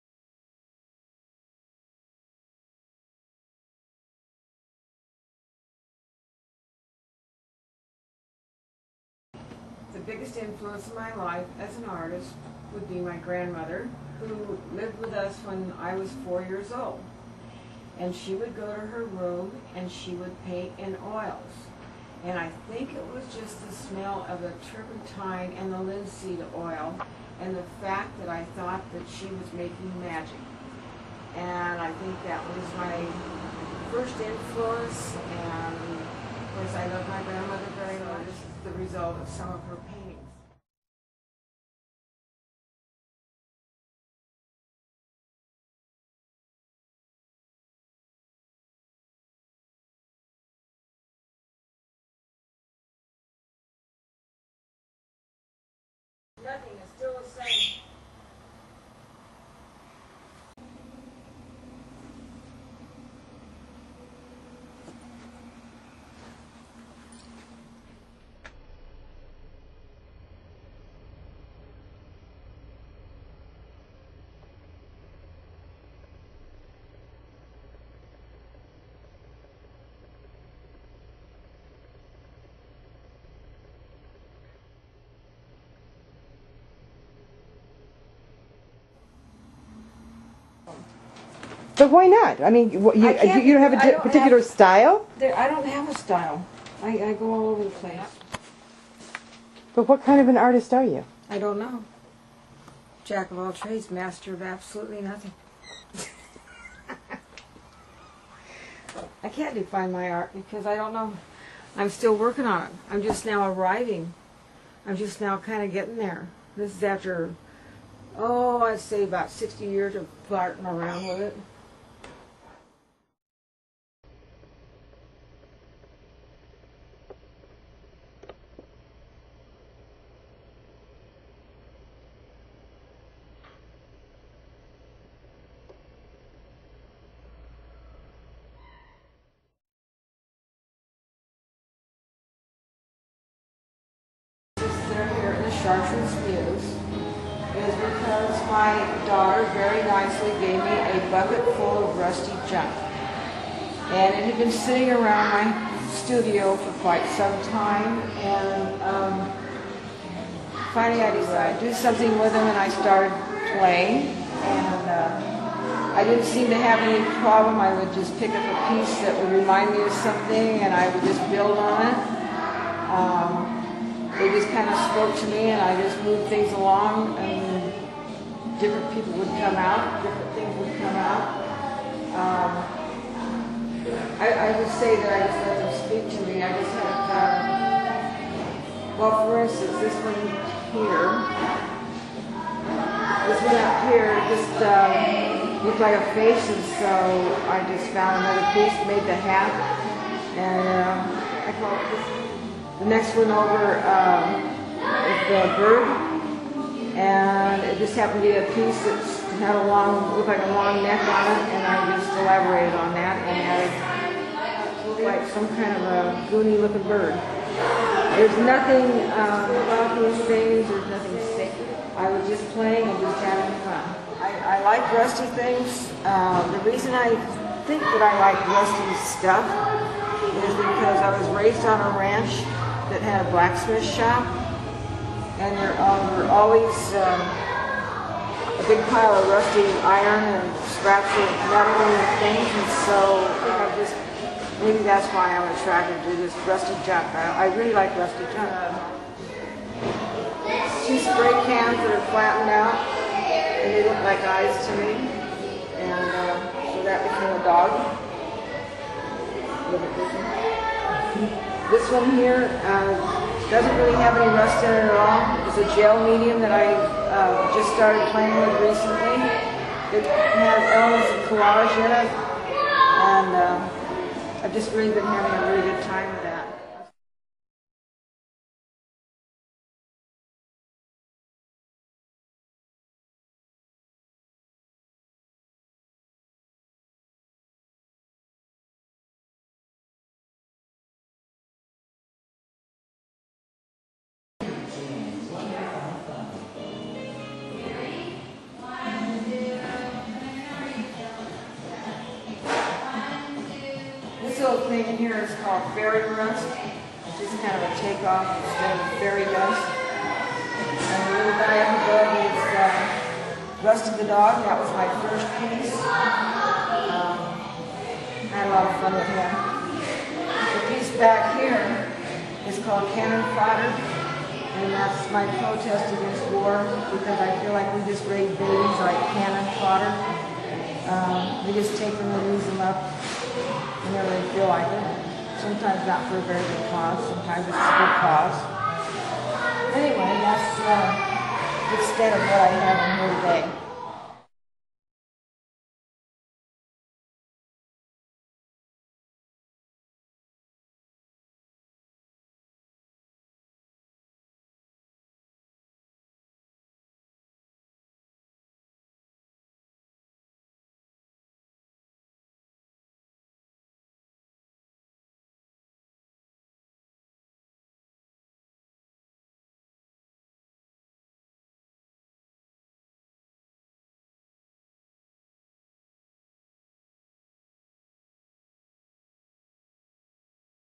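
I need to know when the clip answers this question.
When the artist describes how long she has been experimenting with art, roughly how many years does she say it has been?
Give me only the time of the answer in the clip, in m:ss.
1:59.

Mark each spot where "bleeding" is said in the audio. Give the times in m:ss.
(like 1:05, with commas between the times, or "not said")
not said.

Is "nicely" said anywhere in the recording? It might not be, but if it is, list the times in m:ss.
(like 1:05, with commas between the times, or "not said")
2:29.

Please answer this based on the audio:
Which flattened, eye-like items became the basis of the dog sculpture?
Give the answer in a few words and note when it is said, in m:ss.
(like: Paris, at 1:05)
Two spray cans, at 4:10.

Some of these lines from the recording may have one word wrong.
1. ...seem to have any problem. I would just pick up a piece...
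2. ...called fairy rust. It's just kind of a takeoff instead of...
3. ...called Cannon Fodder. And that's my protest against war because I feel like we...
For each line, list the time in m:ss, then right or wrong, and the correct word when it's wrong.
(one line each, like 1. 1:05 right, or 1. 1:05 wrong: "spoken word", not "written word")
1. 2:46 right
2. 5:05 right
3. 5:22 right.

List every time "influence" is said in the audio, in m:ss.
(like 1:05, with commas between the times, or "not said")
0:10, 0:34.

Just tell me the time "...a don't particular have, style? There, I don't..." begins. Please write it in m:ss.
1:33.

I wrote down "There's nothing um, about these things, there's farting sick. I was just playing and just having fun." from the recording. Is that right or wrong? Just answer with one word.
wrong.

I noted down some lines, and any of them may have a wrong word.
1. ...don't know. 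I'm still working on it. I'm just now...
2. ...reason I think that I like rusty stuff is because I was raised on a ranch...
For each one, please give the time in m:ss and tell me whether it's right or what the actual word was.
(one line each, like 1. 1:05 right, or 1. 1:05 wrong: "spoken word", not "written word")
1. 1:50 right
2. 3:46 right.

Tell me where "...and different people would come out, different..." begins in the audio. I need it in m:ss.
2:57.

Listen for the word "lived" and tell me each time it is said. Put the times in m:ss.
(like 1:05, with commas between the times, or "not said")
0:14.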